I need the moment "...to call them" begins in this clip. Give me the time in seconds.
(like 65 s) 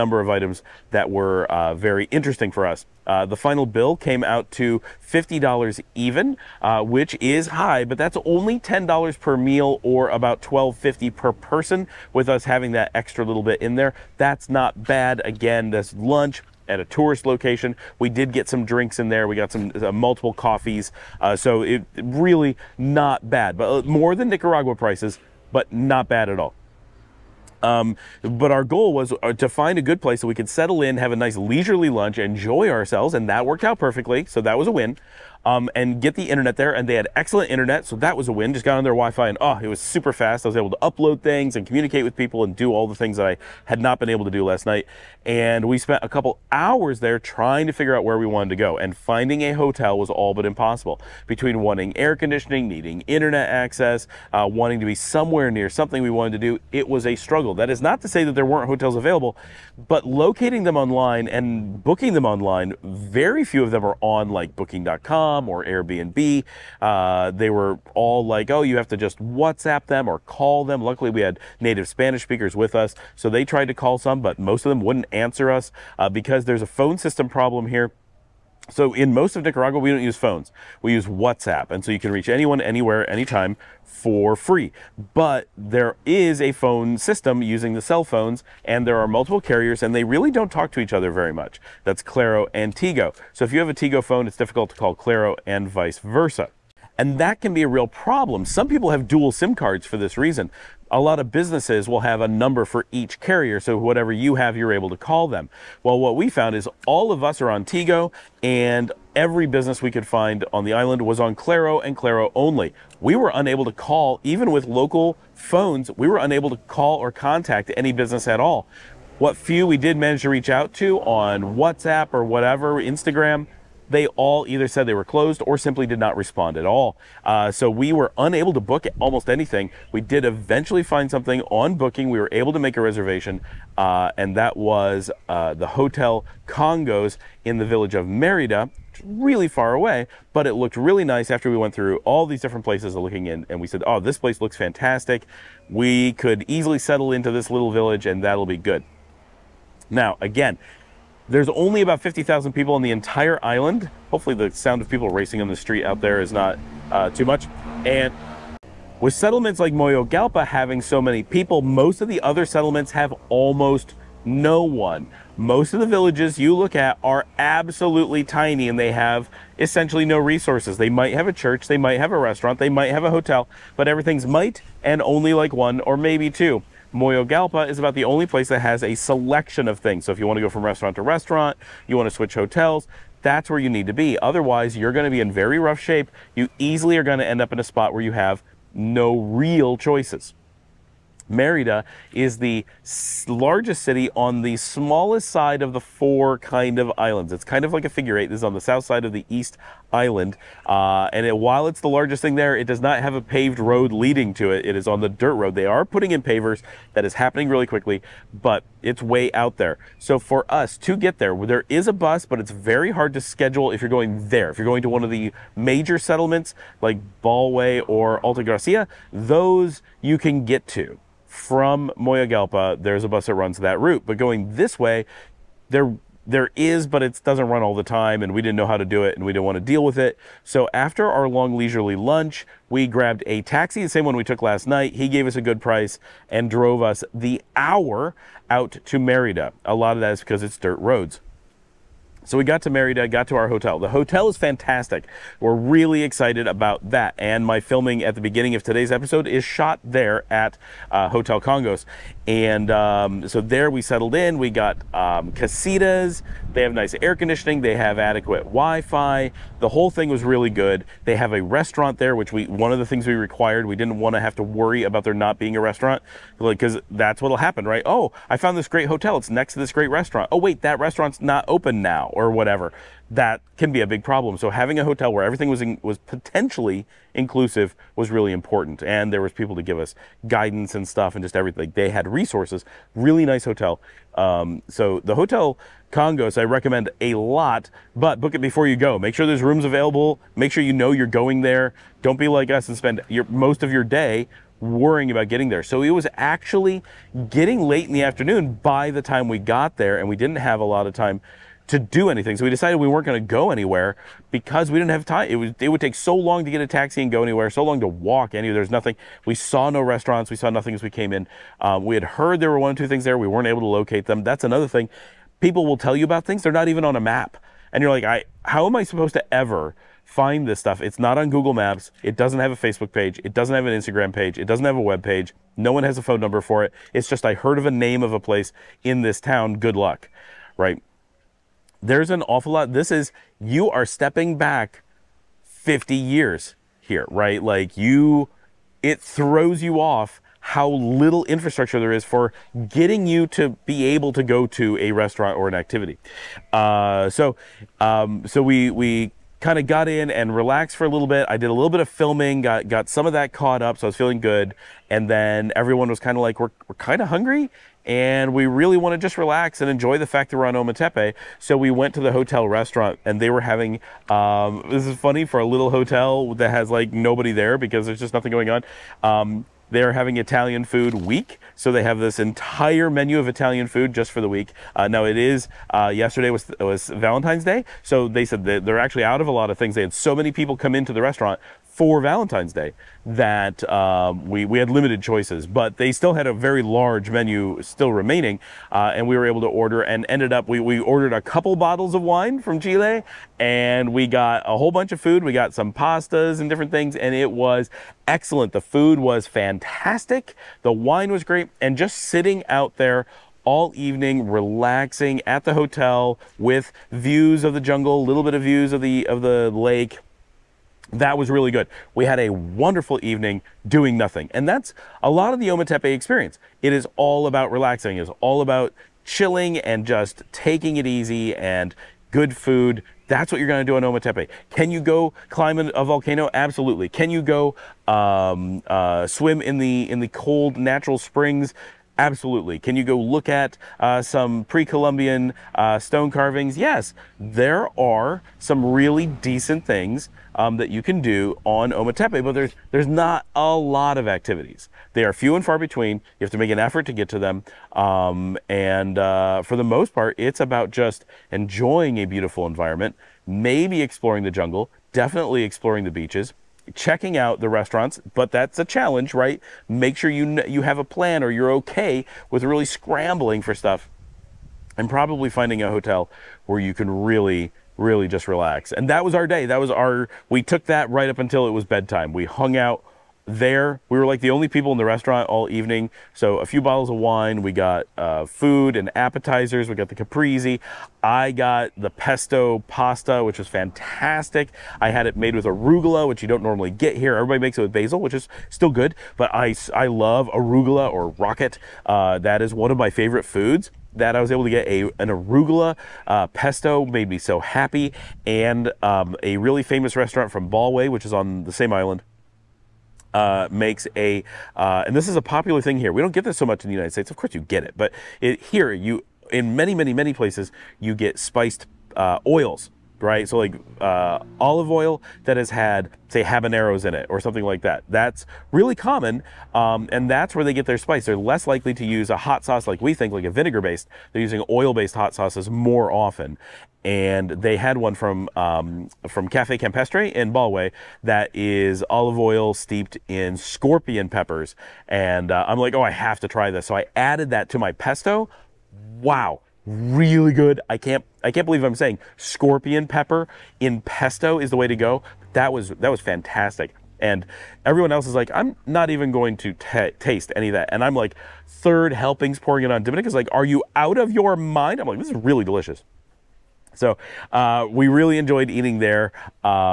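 104 s.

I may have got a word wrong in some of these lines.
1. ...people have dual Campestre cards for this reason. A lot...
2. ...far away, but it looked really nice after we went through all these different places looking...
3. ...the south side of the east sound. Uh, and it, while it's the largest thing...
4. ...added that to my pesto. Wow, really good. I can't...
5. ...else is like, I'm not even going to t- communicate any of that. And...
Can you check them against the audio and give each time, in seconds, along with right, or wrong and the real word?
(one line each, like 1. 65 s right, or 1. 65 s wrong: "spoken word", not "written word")
1. 98 s wrong: "SIM", not "Campestre"
2. 139 s right
3. 198 s wrong: "island", not "sound"
4. 536 s right
5. 547 s wrong: "taste", not "communicate".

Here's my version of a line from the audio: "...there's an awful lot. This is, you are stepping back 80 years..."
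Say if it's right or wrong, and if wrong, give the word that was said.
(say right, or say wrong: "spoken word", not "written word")
wrong: "50", not "80".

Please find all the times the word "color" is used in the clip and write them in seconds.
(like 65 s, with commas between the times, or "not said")
not said.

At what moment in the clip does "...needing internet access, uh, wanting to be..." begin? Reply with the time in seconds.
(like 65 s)
52 s.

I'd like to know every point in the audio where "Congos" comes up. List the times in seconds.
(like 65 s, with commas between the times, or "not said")
136 s, 251 s, 285 s.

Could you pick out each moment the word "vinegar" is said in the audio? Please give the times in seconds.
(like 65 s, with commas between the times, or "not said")
523 s.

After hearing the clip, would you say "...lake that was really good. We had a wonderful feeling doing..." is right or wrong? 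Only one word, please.
wrong.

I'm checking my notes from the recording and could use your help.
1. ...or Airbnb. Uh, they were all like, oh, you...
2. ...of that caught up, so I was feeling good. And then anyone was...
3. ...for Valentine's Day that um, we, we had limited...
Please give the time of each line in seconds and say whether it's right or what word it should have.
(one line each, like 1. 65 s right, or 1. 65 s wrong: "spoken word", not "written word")
1. 65 s right
2. 353 s wrong: "everyone", not "anyone"
3. 381 s right.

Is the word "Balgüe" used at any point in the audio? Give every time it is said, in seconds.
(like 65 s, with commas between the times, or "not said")
217 s, 500 s, 530 s.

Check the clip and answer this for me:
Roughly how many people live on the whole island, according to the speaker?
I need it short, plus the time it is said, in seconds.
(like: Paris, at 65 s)
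50,000, at 151 s.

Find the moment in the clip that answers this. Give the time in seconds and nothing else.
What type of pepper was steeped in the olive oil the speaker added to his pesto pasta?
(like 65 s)
533 s.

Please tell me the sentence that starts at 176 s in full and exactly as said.
Moyogalpa is about the only place that has a selection of things.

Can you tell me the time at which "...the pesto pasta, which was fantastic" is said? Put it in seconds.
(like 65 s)
481 s.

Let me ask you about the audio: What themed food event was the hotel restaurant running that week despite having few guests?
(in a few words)
Italian food week.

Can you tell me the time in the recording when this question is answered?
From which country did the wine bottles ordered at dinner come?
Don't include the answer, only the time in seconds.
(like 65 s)
392 s.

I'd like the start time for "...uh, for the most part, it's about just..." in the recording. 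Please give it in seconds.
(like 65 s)
448 s.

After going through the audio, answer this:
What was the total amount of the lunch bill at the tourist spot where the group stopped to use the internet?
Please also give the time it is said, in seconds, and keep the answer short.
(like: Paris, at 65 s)
$50, at 5 s.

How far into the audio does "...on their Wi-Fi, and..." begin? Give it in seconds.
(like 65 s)
38 s.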